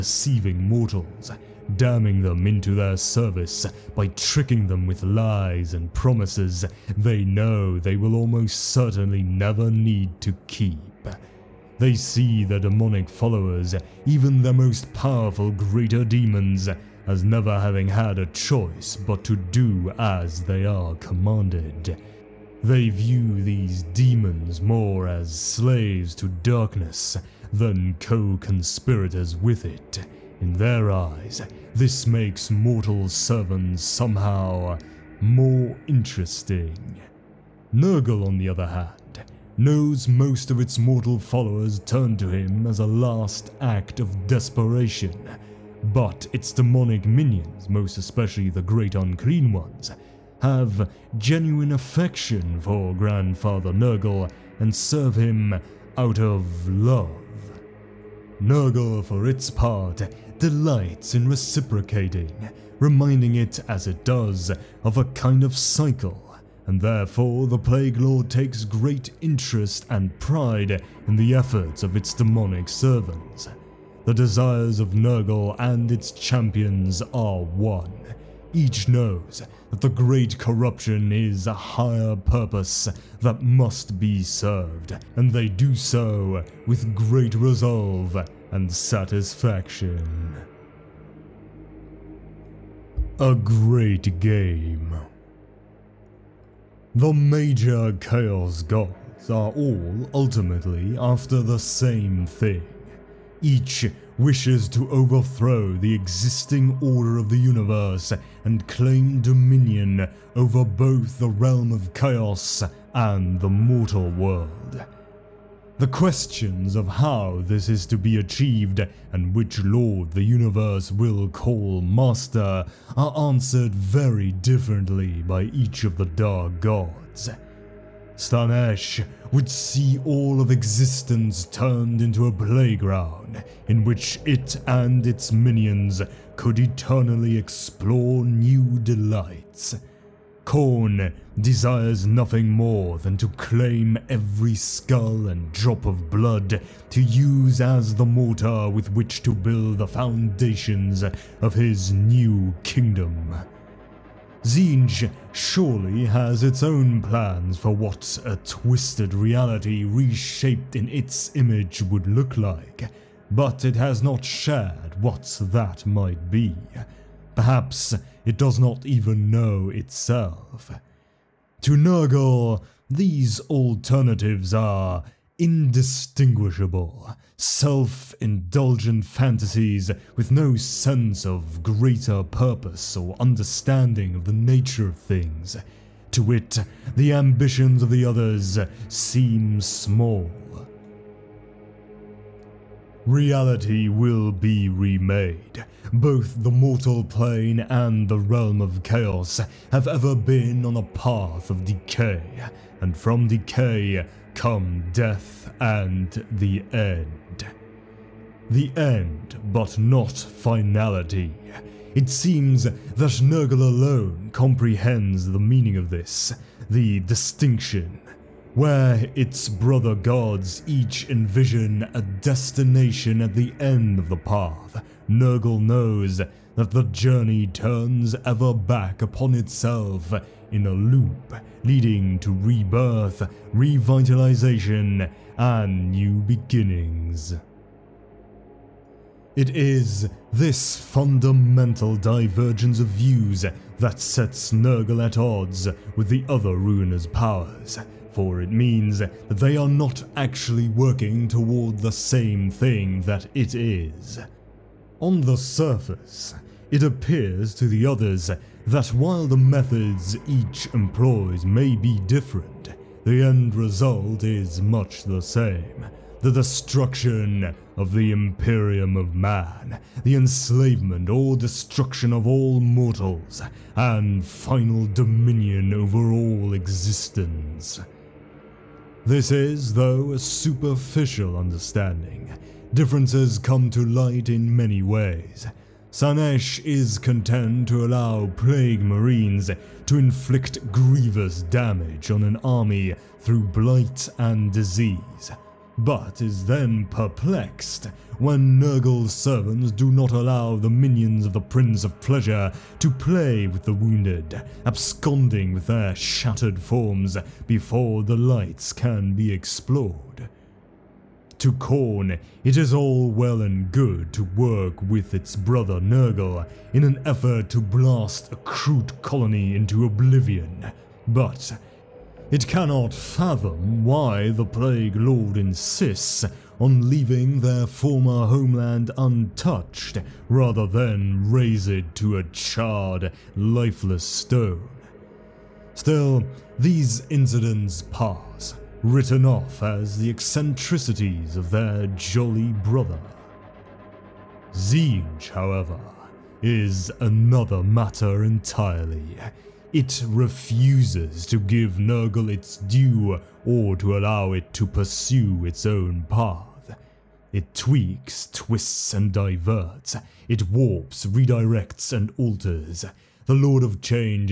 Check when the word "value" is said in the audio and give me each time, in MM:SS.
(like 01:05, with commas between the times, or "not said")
not said.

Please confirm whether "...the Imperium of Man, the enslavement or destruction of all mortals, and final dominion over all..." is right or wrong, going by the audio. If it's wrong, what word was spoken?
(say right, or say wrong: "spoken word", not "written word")
right.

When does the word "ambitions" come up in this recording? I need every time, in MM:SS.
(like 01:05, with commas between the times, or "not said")
03:07.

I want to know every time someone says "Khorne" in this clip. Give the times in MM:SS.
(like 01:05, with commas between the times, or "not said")
02:20, 05:11.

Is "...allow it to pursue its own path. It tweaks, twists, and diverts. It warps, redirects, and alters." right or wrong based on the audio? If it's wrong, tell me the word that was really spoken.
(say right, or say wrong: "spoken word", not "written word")
right.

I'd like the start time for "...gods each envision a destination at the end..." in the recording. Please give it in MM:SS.
03:39.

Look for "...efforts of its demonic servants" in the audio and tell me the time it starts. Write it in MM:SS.
01:11.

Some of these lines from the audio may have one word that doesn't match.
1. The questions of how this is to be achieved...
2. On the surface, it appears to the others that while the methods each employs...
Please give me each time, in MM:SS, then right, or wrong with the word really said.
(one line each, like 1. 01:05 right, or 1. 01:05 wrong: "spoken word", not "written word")
1. 01:55 right
2. 04:14 right.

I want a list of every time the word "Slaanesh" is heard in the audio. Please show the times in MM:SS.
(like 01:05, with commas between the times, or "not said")
02:08, 04:45.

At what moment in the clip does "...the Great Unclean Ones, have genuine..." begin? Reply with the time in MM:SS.
00:48.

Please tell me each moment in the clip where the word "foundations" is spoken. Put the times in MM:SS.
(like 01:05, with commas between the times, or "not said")
02:29.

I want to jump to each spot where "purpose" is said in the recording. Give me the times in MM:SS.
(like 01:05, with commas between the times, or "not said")
01:22, 03:02.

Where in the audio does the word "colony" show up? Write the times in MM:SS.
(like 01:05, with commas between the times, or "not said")
05:19.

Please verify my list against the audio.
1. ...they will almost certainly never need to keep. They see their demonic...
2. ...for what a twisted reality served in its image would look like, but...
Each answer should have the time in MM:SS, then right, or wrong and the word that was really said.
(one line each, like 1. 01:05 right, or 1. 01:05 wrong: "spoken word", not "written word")
1. 00:07 right
2. 02:37 wrong: "reshaped", not "served".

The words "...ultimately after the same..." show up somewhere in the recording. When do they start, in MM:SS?
01:40.